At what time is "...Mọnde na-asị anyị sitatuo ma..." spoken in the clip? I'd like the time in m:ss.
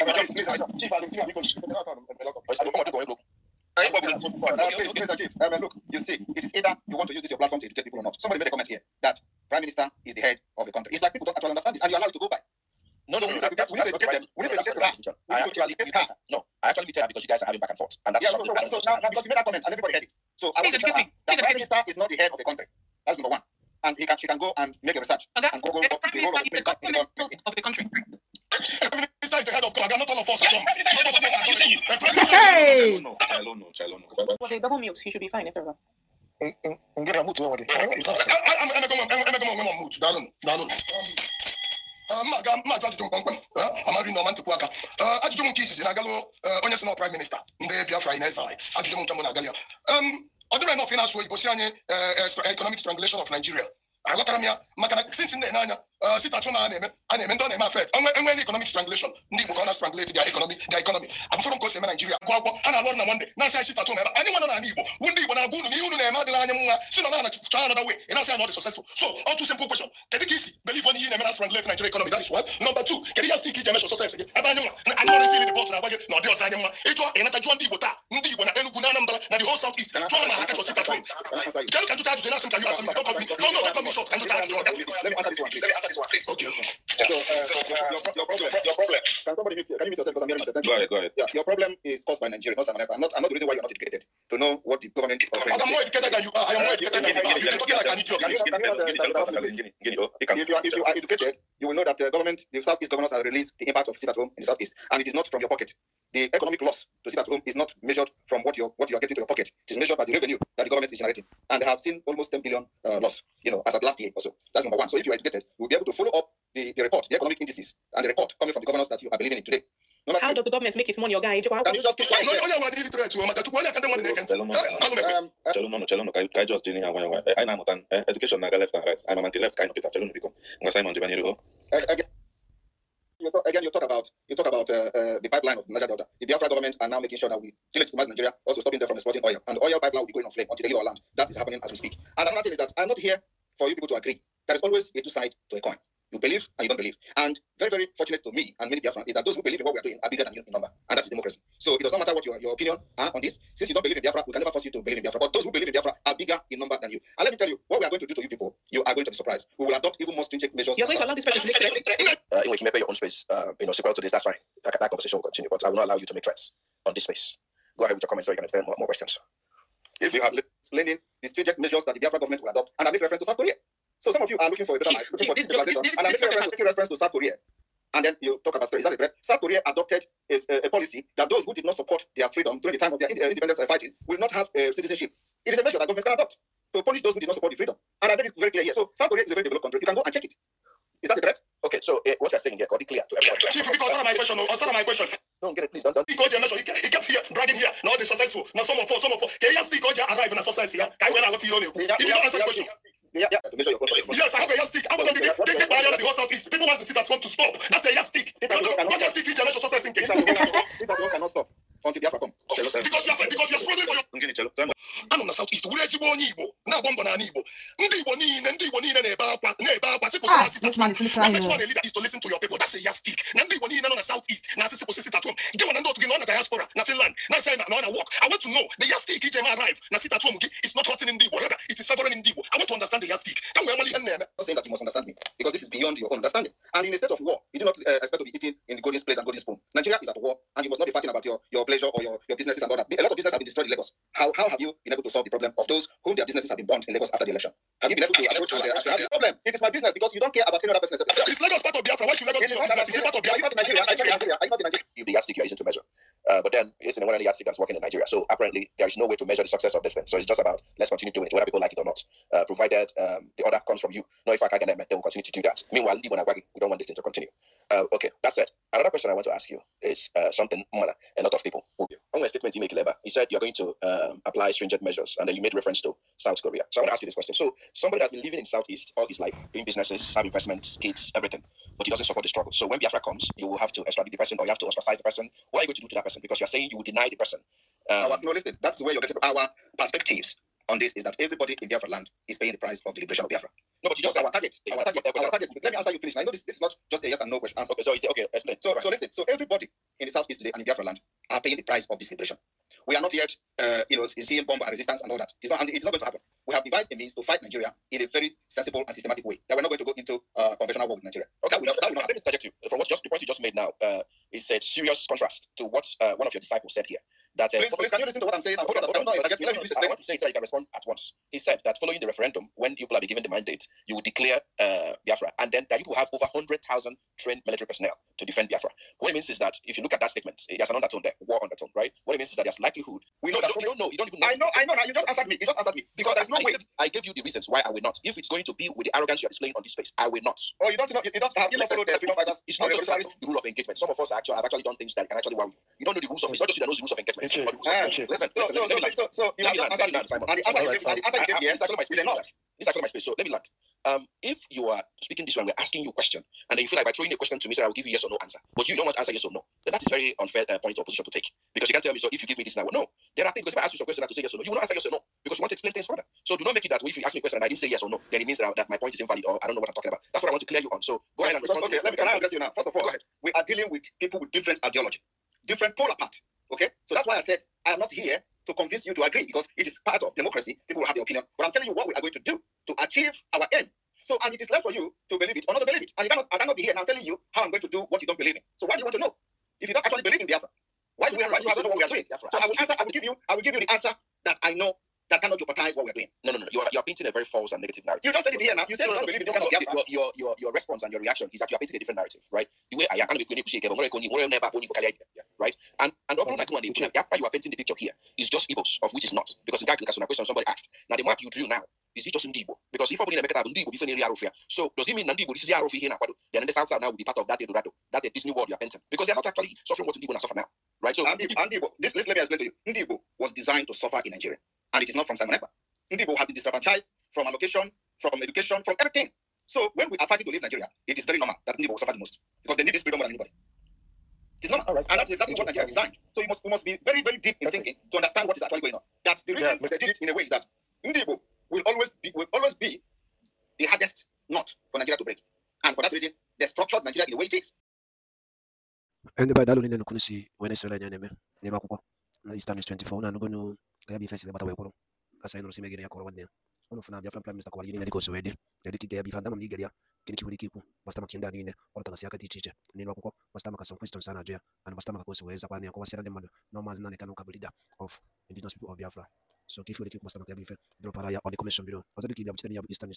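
1:03.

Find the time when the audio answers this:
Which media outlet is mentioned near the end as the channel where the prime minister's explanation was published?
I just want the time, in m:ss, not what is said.
7:32.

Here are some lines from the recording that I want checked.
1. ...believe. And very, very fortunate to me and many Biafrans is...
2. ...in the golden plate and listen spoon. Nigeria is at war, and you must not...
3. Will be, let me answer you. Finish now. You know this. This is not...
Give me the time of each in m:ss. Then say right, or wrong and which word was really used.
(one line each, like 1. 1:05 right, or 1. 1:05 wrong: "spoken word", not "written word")
1. 2:26 right
2. 3:58 wrong: "golden", not "listen"
3. 4:55 right.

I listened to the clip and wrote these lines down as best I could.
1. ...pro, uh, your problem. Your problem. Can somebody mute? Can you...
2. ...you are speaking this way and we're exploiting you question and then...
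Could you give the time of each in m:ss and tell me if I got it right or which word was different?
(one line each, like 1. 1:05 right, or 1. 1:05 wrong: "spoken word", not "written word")
1. 1:27 right
2. 5:54 wrong: "asking", not "exploiting".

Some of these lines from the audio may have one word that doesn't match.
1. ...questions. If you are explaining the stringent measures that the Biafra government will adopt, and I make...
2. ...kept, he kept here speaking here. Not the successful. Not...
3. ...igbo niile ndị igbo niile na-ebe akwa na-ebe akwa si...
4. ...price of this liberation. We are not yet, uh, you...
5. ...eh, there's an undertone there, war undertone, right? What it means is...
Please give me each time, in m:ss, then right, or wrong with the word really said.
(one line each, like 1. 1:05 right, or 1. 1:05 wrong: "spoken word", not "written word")
1. 2:48 right
2. 3:16 wrong: "bragging", not "speaking"
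3. 3:37 right
4. 5:01 right
5. 5:30 right.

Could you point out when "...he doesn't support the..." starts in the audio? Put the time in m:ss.
4:41.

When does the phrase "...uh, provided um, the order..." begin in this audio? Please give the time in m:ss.
4:22.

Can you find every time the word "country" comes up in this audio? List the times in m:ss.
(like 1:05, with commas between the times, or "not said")
0:10, 0:22, 0:27, 3:09.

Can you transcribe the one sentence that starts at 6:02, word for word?
No, there are things because if I ask you some question, I have to say yes or no.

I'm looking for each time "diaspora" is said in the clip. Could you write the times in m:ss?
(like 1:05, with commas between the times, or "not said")
3:46.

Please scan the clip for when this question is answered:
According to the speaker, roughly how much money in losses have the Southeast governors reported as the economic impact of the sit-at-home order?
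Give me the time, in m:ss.
1:52.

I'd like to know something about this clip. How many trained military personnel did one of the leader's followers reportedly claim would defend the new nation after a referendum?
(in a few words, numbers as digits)
100,000.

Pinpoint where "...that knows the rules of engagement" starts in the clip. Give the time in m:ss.
5:46.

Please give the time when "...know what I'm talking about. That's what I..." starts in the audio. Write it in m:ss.
6:09.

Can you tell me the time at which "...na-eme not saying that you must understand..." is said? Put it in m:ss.
3:54.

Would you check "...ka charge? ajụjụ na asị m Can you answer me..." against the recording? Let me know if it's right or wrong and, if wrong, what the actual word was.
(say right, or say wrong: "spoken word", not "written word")
right.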